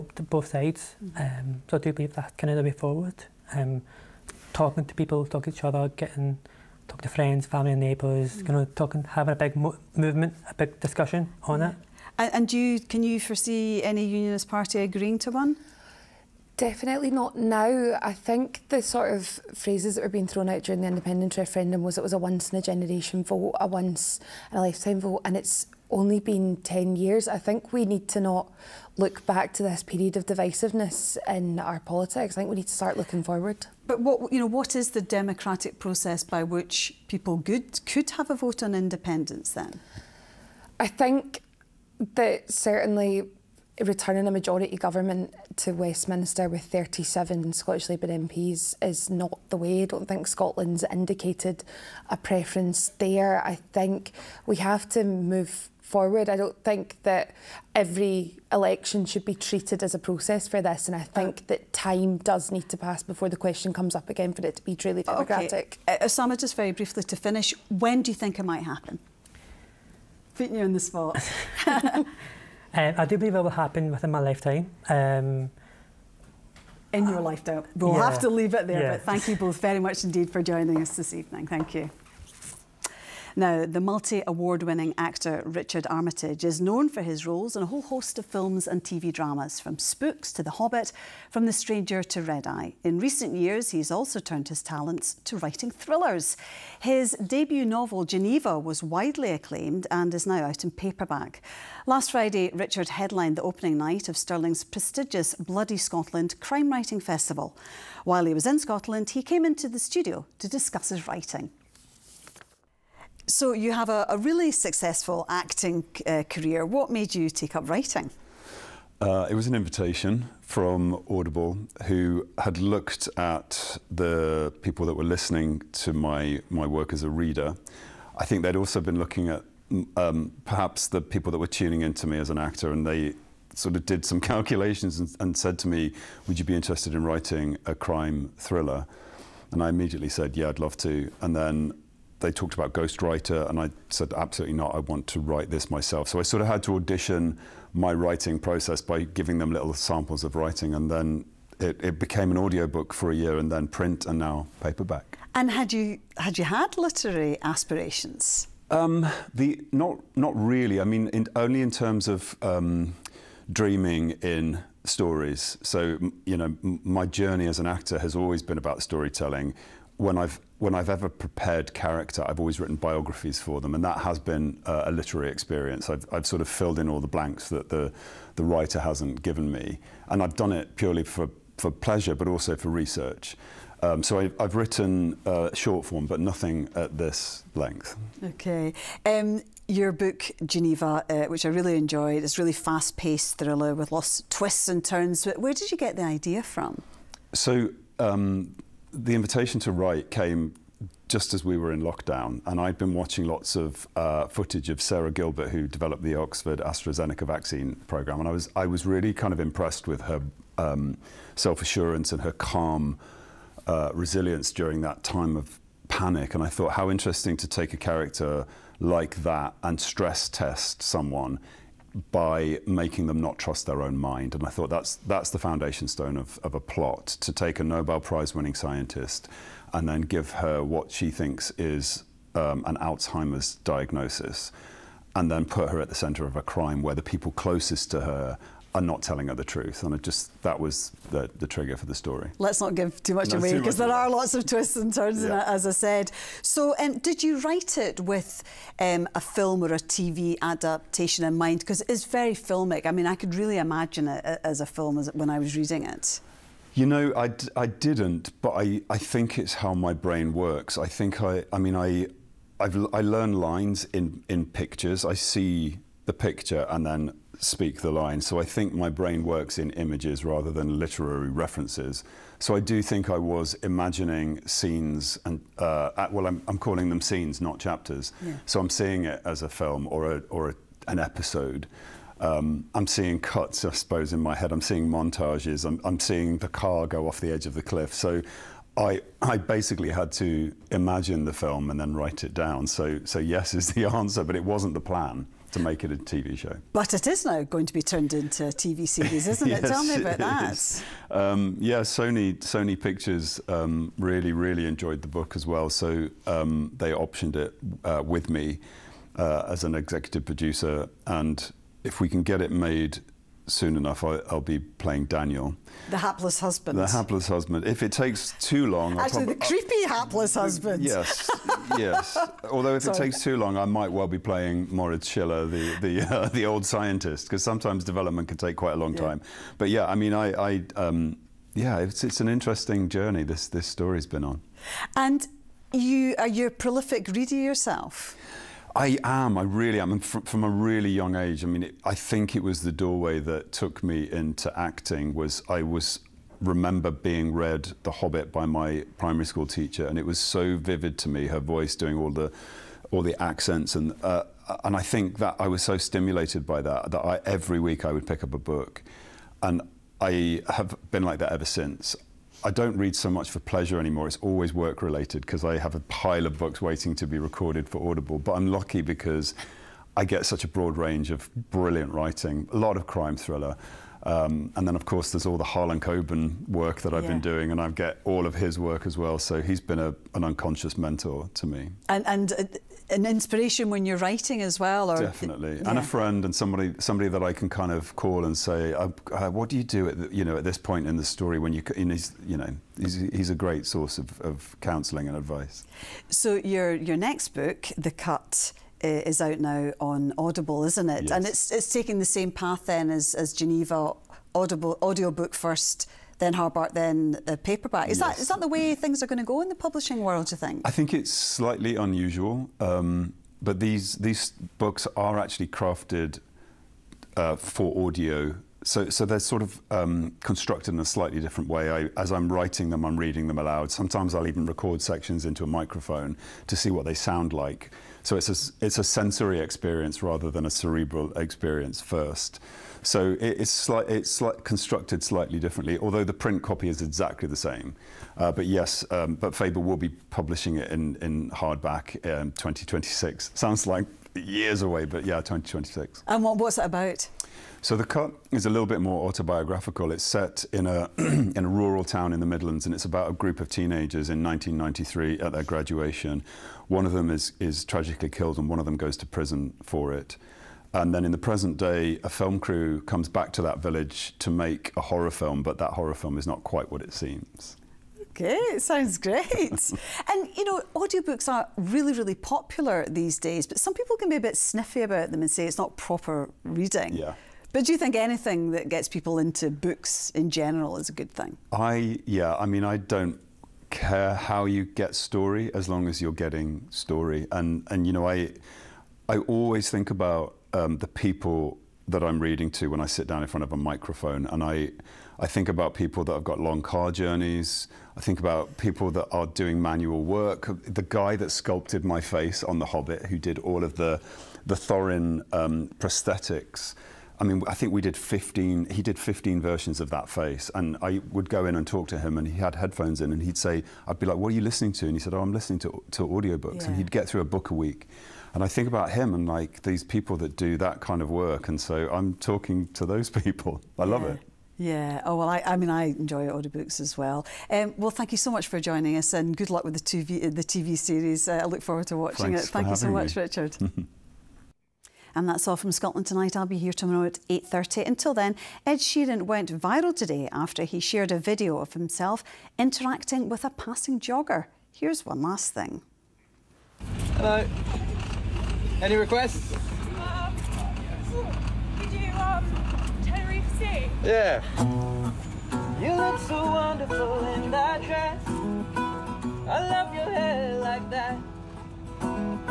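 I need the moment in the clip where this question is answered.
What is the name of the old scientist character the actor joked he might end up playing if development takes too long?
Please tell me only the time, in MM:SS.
05:24.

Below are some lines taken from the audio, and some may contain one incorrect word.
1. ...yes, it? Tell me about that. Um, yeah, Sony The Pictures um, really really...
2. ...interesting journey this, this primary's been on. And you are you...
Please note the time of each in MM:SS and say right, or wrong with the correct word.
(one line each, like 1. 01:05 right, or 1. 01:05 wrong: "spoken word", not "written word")
1. 04:59 wrong: "Sony", not "The"
2. 05:32 wrong: "story", not "primary".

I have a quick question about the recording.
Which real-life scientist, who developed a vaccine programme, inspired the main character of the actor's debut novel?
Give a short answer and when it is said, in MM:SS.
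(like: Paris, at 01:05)
Sarah Gilbert, at 03:24.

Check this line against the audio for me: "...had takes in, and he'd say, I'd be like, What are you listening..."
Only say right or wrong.
wrong.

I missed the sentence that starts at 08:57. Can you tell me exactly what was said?
Until then, Ed Sheeran went viral today after he shared a video of himself interacting with a passing jogger.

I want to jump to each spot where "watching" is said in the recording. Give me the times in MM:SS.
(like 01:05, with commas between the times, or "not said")
03:22, 08:51.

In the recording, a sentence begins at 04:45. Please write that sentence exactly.
I'm, I'm seeing the car go off the edge of the cliff.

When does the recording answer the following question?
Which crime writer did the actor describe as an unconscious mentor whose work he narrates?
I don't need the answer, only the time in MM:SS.
06:15.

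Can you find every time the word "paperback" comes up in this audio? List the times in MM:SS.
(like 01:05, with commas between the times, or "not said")
01:40, 02:34, 06:47.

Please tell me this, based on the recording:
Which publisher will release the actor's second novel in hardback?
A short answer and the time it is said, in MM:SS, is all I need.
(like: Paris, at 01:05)
Faber, at 07:19.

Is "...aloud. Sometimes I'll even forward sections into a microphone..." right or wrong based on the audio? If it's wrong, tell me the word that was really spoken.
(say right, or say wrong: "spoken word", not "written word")
wrong: "record", not "forward".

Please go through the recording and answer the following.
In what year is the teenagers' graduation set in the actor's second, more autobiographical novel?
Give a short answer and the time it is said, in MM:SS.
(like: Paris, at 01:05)
1993, at 07:34.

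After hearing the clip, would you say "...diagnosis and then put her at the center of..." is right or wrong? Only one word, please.
right.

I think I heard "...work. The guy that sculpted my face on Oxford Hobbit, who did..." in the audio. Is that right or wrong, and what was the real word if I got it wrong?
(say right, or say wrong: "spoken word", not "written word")
wrong: "The", not "Oxford".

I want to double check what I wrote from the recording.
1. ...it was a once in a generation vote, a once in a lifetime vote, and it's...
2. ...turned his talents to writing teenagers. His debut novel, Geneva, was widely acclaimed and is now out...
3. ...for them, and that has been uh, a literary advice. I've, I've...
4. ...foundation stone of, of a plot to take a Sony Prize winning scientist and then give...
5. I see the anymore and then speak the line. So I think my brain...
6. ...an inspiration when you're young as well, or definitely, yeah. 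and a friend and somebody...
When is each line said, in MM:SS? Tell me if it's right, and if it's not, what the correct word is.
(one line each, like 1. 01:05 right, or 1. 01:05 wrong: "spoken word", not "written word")
1. 00:21 right
2. 01:34 wrong: "thrillers", not "teenagers"
3. 02:53 wrong: "experience", not "advice"
4. 03:45 wrong: "Nobel", not "Sony"
5. 04:25 wrong: "picture", not "anymore"
6. 06:22 wrong: "writing", not "young".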